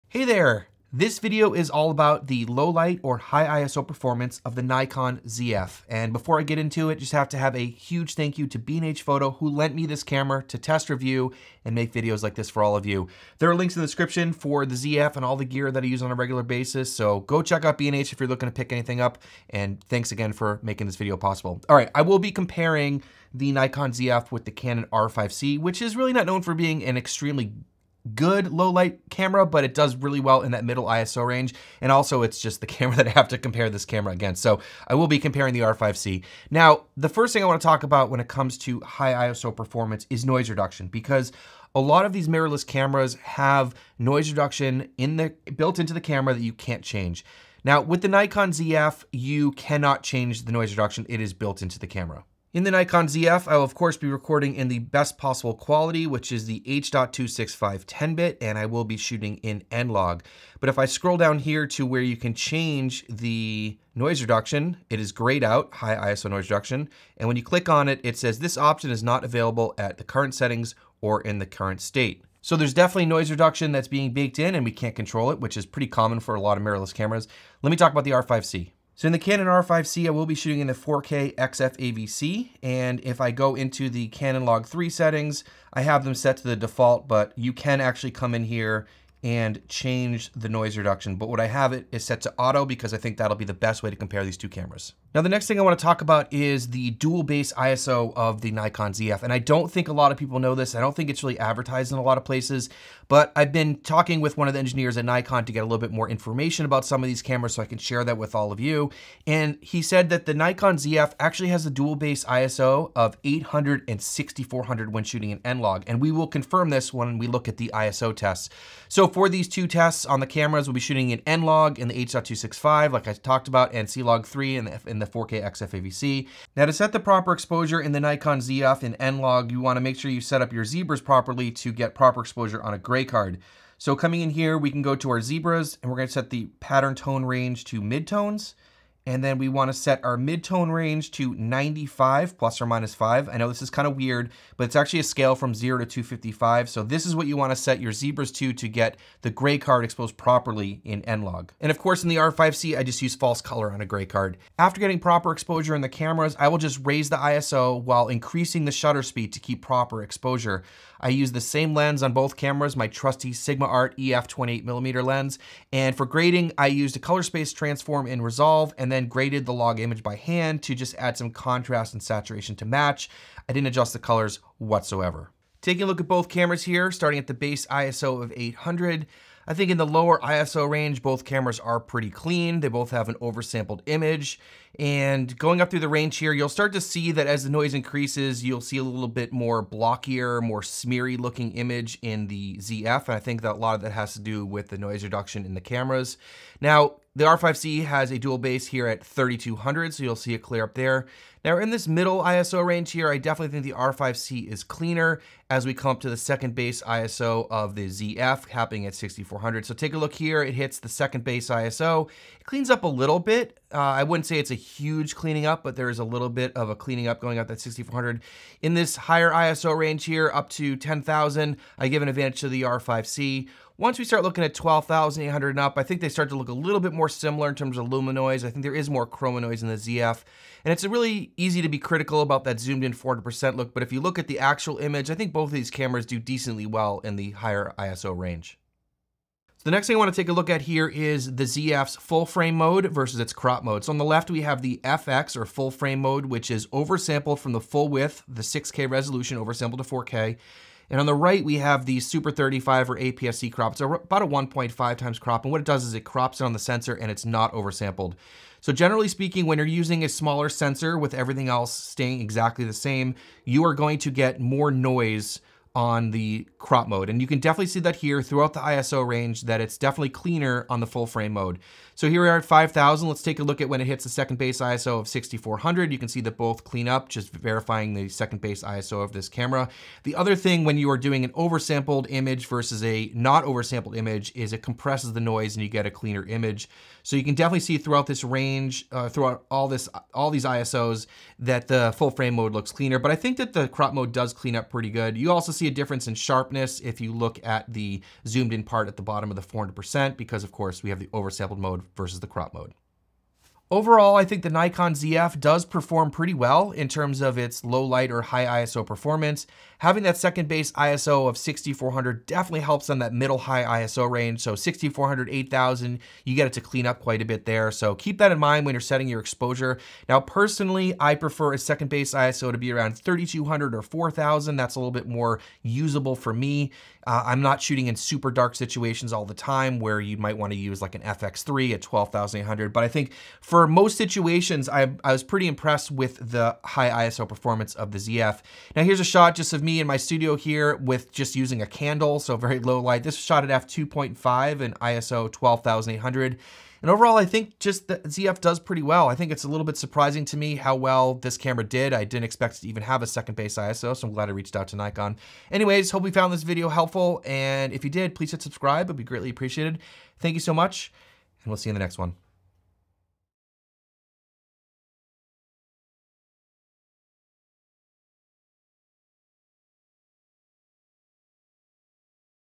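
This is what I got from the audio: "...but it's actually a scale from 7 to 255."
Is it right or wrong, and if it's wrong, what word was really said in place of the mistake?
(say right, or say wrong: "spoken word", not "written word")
wrong: "0", not "7".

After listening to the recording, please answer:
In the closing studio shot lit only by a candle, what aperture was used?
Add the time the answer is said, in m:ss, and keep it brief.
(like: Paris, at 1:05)
f2.5, at 5:43.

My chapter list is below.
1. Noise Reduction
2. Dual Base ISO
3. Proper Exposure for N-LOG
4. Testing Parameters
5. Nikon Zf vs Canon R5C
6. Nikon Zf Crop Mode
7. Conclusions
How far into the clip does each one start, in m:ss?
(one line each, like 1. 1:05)
1. 0:36
2. 1:34
3. 2:06
4. 2:34
5. 2:55
6. 3:57
7. 5:03.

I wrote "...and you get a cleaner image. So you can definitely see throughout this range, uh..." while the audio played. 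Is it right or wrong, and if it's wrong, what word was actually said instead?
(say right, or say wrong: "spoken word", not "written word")
right.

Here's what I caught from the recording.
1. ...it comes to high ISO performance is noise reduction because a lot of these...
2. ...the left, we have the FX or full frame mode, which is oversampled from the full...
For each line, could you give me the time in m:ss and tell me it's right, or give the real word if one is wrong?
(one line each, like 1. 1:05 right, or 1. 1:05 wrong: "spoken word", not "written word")
1. 0:38 right
2. 4:03 right.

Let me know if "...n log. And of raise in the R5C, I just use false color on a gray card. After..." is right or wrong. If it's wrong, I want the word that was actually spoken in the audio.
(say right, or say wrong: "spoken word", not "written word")
wrong: "course", not "raise".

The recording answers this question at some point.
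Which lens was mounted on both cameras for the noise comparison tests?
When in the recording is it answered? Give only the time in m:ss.
2:43.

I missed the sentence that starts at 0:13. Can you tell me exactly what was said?
There are links in the description for the ZF and all the gear that I use on a regular basis.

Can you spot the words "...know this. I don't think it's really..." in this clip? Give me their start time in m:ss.
1:40.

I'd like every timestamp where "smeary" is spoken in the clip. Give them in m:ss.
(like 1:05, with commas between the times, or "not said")
3:10.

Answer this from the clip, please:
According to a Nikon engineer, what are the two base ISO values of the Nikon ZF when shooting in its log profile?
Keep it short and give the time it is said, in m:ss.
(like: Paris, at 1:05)
800 and 6400, at 1:53.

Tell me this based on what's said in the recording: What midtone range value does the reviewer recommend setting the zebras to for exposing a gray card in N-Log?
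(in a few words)
95 plus or minus 5.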